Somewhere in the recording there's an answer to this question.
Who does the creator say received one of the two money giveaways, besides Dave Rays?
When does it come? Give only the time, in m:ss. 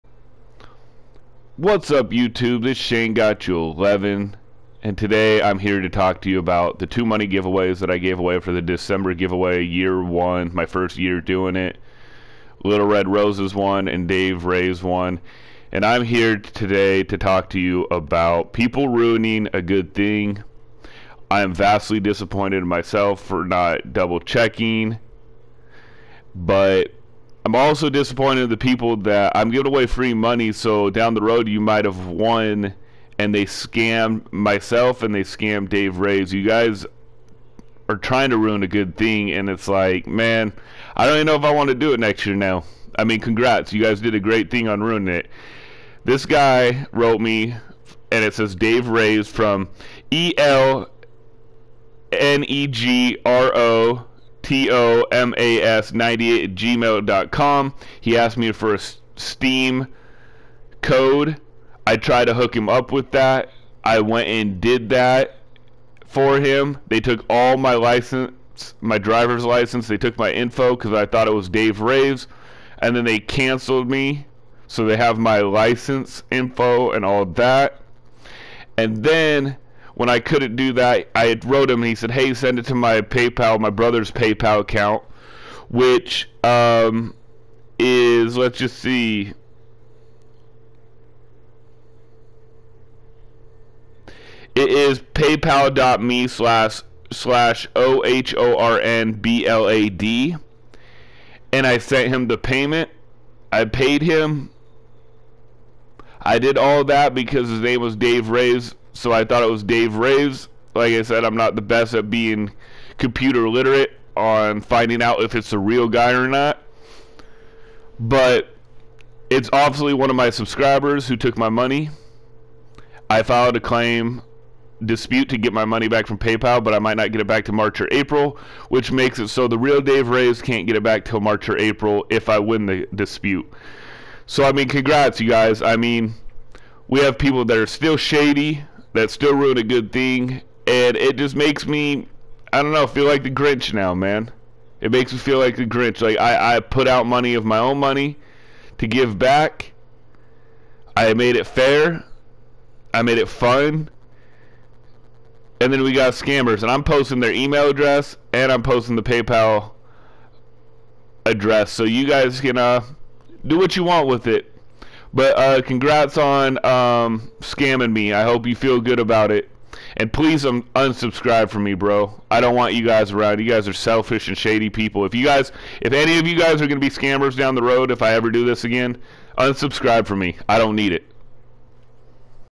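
0:12.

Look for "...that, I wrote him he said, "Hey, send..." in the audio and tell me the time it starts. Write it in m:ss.
1:20.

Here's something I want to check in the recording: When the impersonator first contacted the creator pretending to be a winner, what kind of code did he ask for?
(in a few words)
Steam code.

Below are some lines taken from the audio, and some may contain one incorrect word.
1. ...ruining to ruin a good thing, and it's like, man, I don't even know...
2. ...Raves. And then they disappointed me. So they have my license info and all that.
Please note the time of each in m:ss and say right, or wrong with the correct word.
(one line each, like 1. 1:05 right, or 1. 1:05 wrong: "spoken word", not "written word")
1. 0:37 wrong: "trying", not "ruining"
2. 1:11 wrong: "canceled", not "disappointed".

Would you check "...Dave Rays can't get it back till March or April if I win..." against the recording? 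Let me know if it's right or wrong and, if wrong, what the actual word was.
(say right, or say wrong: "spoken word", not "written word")
wrong: "Raves", not "Rays".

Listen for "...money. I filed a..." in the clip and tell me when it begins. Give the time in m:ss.
2:01.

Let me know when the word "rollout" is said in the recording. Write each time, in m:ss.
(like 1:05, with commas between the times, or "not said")
not said.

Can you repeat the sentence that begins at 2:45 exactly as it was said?
But uh, congrats on um, scamming me.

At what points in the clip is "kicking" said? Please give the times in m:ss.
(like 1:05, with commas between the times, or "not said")
not said.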